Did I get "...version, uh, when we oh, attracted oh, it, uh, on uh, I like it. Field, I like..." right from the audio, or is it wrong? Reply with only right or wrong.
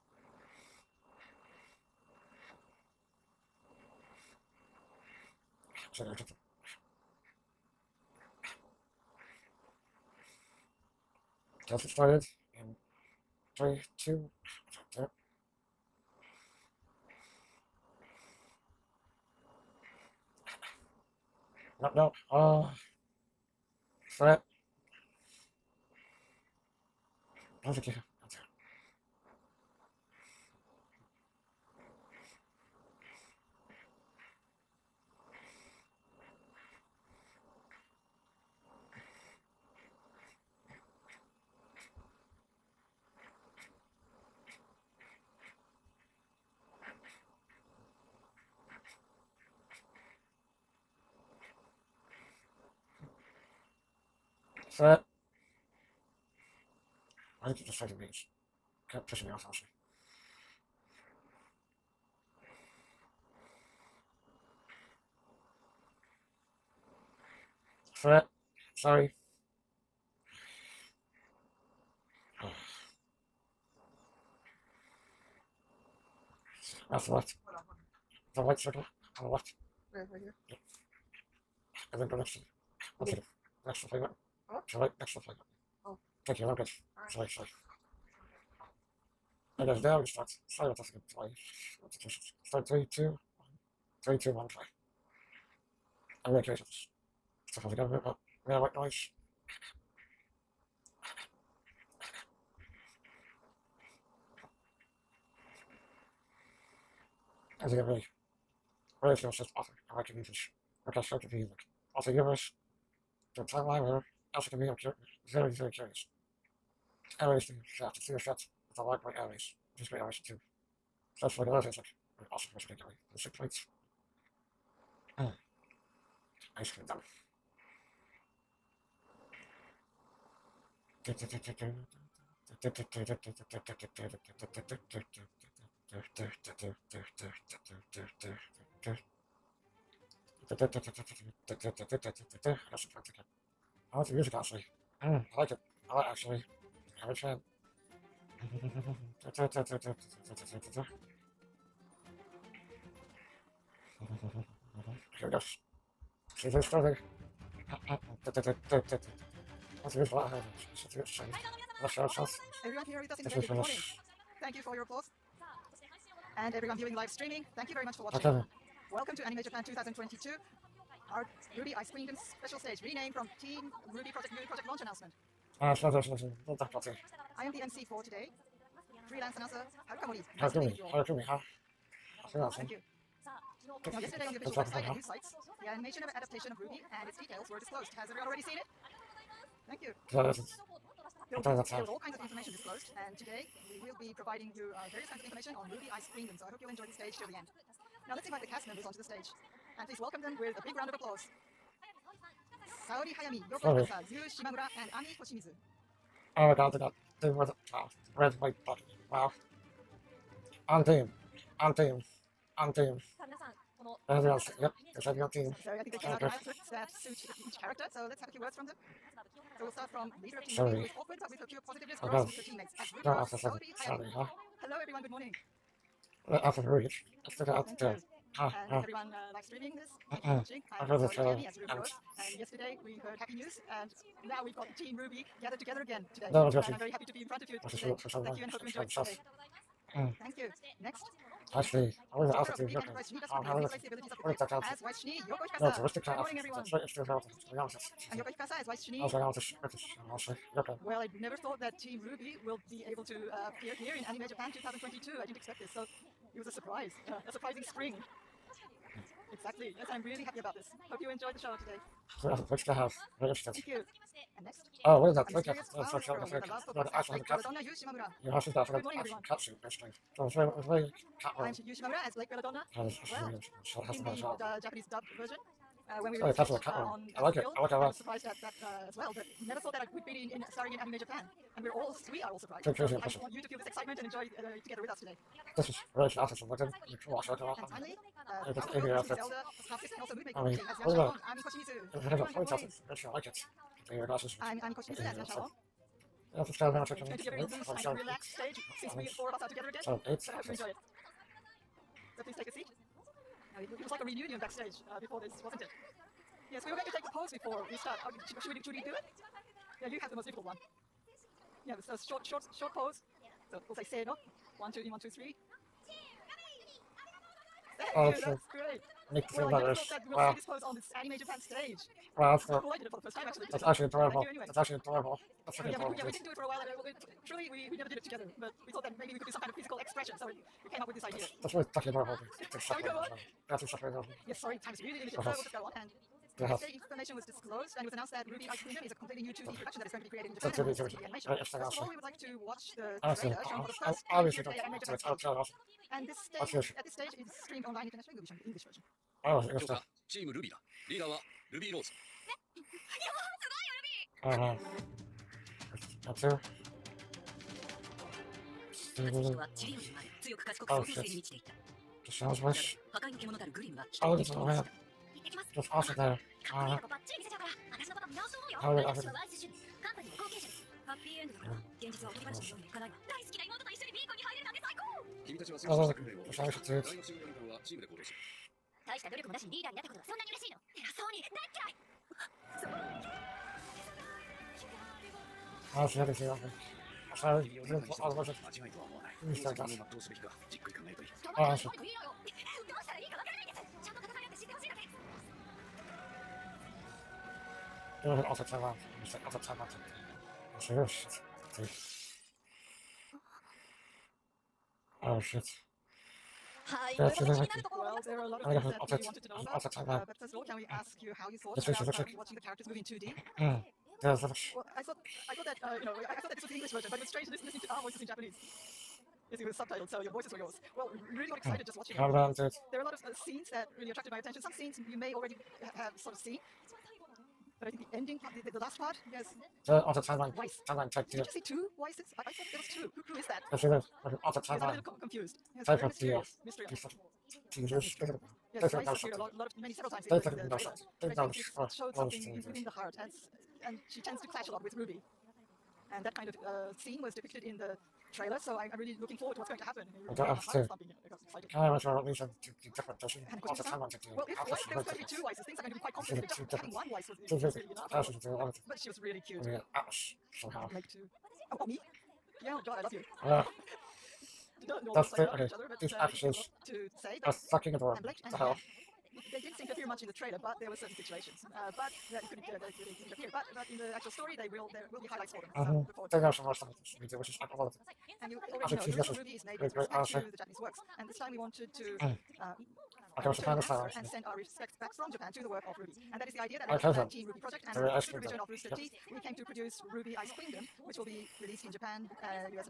wrong.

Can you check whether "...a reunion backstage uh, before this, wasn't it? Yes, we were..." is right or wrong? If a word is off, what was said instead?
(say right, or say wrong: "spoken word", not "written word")
right.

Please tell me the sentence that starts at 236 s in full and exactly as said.
And I'm very happy to be in front of you today.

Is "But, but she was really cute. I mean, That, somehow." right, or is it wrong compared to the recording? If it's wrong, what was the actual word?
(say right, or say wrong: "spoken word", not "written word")
wrong: "Atlas", not "That".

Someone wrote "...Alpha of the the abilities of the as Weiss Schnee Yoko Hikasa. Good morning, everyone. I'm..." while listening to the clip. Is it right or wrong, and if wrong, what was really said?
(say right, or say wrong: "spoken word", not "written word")
right.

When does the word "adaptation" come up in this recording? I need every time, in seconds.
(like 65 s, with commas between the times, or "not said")
186 s.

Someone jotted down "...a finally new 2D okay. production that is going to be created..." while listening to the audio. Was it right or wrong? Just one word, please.
wrong.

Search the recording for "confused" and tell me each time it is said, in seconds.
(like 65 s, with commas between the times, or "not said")
434 s.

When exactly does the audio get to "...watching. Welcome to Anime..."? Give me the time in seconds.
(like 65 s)
168 s.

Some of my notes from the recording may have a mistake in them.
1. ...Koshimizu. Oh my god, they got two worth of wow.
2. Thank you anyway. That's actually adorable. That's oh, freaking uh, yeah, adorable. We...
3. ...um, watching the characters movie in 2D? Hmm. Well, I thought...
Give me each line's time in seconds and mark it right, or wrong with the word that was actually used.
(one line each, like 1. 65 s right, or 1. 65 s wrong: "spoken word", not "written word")
1. 205 s right
2. 324 s right
3. 411 s right.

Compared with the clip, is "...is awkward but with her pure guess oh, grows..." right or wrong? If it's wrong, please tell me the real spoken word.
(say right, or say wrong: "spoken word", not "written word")
wrong: "positiveness", not "guess".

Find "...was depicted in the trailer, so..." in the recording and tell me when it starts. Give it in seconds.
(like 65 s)
447 s.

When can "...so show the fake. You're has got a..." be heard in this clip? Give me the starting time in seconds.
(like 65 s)
265 s.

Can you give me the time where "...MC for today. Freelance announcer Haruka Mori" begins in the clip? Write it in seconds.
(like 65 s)
177 s.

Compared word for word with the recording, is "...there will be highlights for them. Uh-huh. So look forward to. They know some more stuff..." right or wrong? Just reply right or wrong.
right.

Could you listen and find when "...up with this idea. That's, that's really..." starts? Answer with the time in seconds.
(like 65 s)
330 s.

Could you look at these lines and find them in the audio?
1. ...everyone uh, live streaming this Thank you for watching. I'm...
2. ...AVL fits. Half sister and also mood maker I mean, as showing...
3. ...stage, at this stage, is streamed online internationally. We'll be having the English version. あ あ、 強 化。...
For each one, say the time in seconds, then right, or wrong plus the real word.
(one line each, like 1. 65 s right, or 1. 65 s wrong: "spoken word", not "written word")
1. 228 s right
2. 288 s wrong: "young", not "showing"
3. 346 s wrong: "showing", not "having".